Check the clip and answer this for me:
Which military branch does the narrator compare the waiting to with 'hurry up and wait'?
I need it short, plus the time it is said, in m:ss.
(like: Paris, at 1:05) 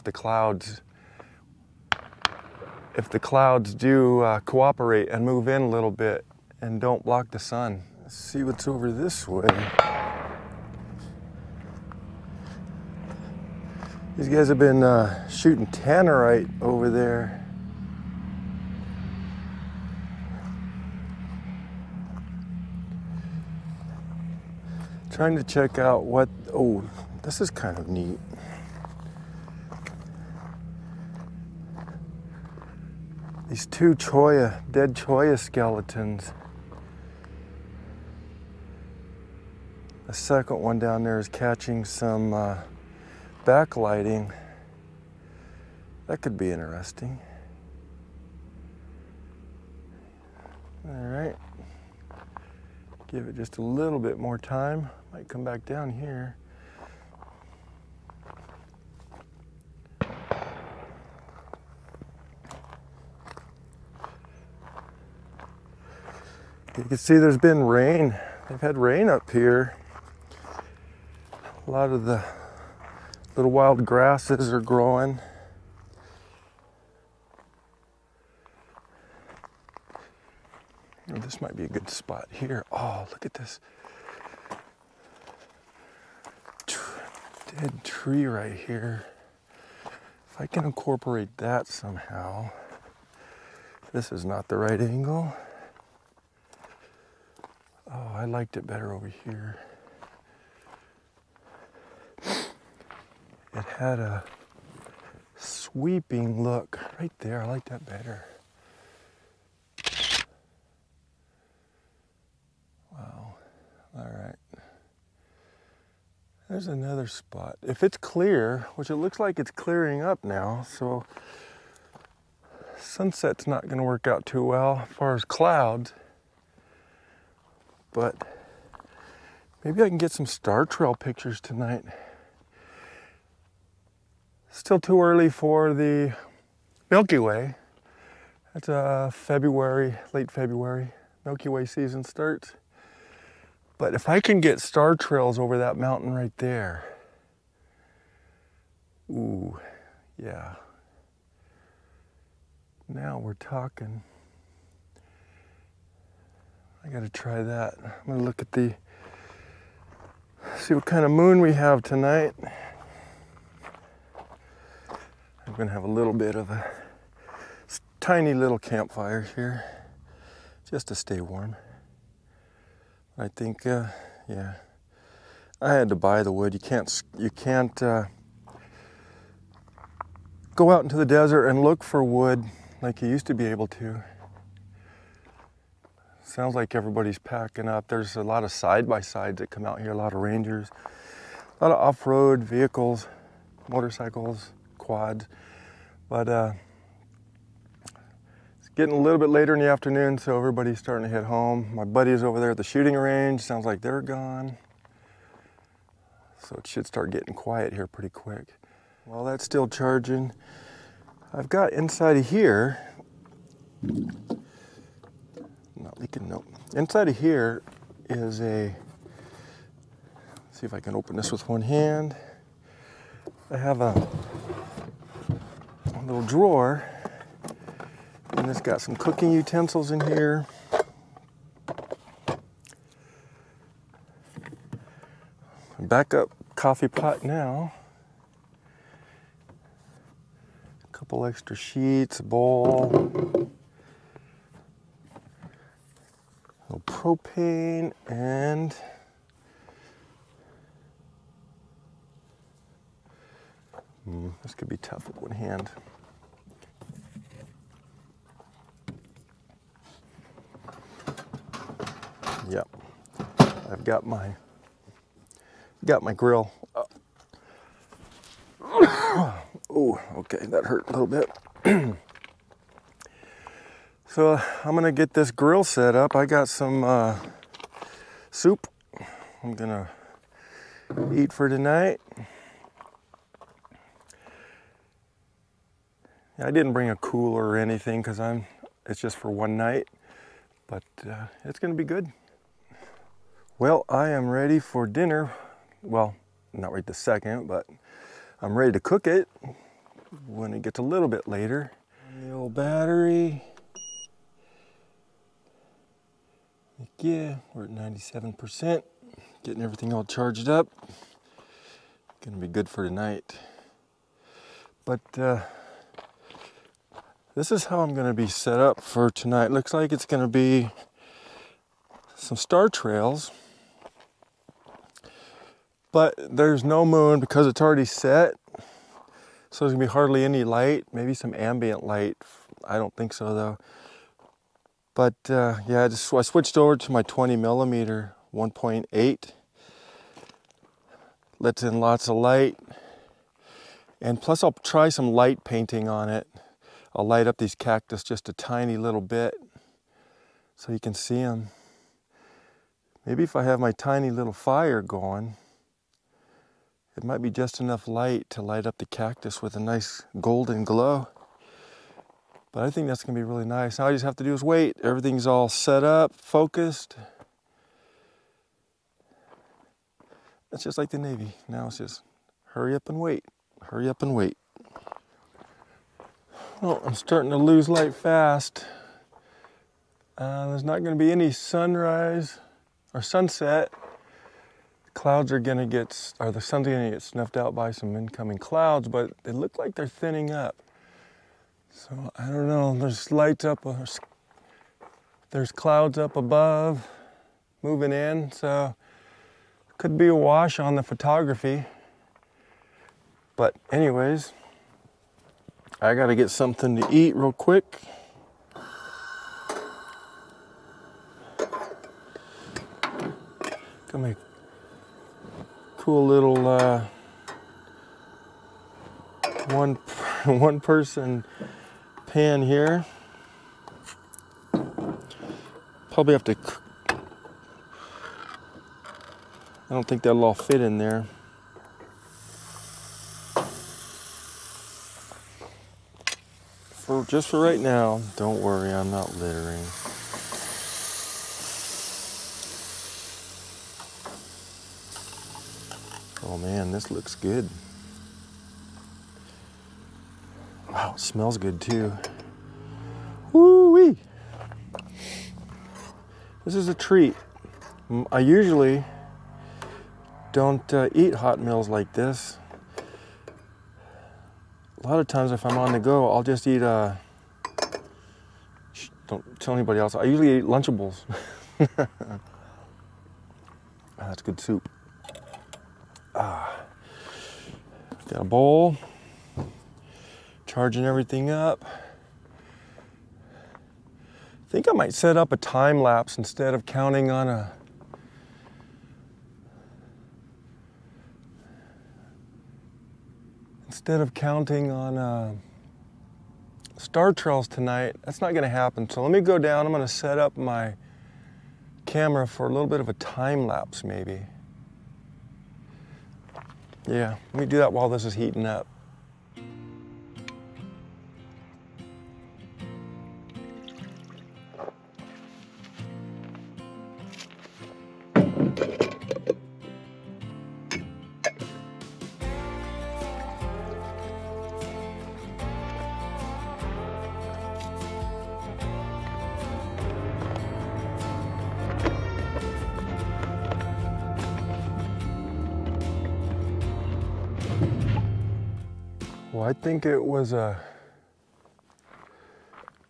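Navy, at 6:10.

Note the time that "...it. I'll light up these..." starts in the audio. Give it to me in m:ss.
5:46.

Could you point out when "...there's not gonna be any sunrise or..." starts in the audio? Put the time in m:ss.
6:20.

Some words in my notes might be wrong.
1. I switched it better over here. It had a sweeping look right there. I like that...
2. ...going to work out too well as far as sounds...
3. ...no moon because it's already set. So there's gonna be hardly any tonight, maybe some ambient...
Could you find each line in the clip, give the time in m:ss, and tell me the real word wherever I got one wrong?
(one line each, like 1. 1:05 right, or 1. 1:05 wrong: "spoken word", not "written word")
1. 1:38 wrong: "liked", not "switched"
2. 2:03 wrong: "clouds", not "sounds"
3. 5:26 wrong: "light", not "tonight".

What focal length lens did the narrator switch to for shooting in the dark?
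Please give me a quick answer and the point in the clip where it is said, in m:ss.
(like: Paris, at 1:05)
20 millimeter, at 5:37.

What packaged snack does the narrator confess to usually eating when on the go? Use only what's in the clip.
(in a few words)
Lunchables.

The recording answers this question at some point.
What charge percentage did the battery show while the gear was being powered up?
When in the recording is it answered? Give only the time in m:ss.
5:07.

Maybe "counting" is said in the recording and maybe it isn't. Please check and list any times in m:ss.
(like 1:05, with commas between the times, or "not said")
8:06, 8:14.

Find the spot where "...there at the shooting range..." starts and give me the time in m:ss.
3:22.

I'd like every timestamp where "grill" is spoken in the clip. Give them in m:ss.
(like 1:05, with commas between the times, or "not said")
4:26, 4:35.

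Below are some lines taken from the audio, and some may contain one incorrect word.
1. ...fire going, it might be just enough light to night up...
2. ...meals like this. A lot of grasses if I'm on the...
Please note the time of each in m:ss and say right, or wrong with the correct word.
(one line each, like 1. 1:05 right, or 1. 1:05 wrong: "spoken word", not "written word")
1. 5:54 wrong: "light", not "night"
2. 7:41 wrong: "times", not "grasses".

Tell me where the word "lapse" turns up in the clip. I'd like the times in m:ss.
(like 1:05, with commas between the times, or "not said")
8:05, 8:23.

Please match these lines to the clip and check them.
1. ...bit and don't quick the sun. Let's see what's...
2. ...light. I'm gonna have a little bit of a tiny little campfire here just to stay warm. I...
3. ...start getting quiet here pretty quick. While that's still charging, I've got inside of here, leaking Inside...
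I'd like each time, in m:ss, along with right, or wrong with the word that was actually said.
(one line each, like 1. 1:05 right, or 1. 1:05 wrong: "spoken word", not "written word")
1. 0:05 wrong: "block", not "quick"
2. 2:41 wrong: "tonight", not "light"
3. 3:26 right.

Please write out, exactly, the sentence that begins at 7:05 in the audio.
Probably have to, I don't think that'll all fit in there.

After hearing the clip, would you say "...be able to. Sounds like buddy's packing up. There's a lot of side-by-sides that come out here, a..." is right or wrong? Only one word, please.
wrong.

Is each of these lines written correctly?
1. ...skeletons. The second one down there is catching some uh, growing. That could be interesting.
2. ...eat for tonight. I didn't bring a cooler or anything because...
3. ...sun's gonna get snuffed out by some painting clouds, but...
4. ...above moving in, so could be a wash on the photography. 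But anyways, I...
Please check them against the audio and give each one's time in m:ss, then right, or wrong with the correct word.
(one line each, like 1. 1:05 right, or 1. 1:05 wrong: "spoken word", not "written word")
1. 0:35 wrong: "backlighting", not "growing"
2. 4:41 right
3. 6:26 wrong: "incoming", not "painting"
4. 6:36 right.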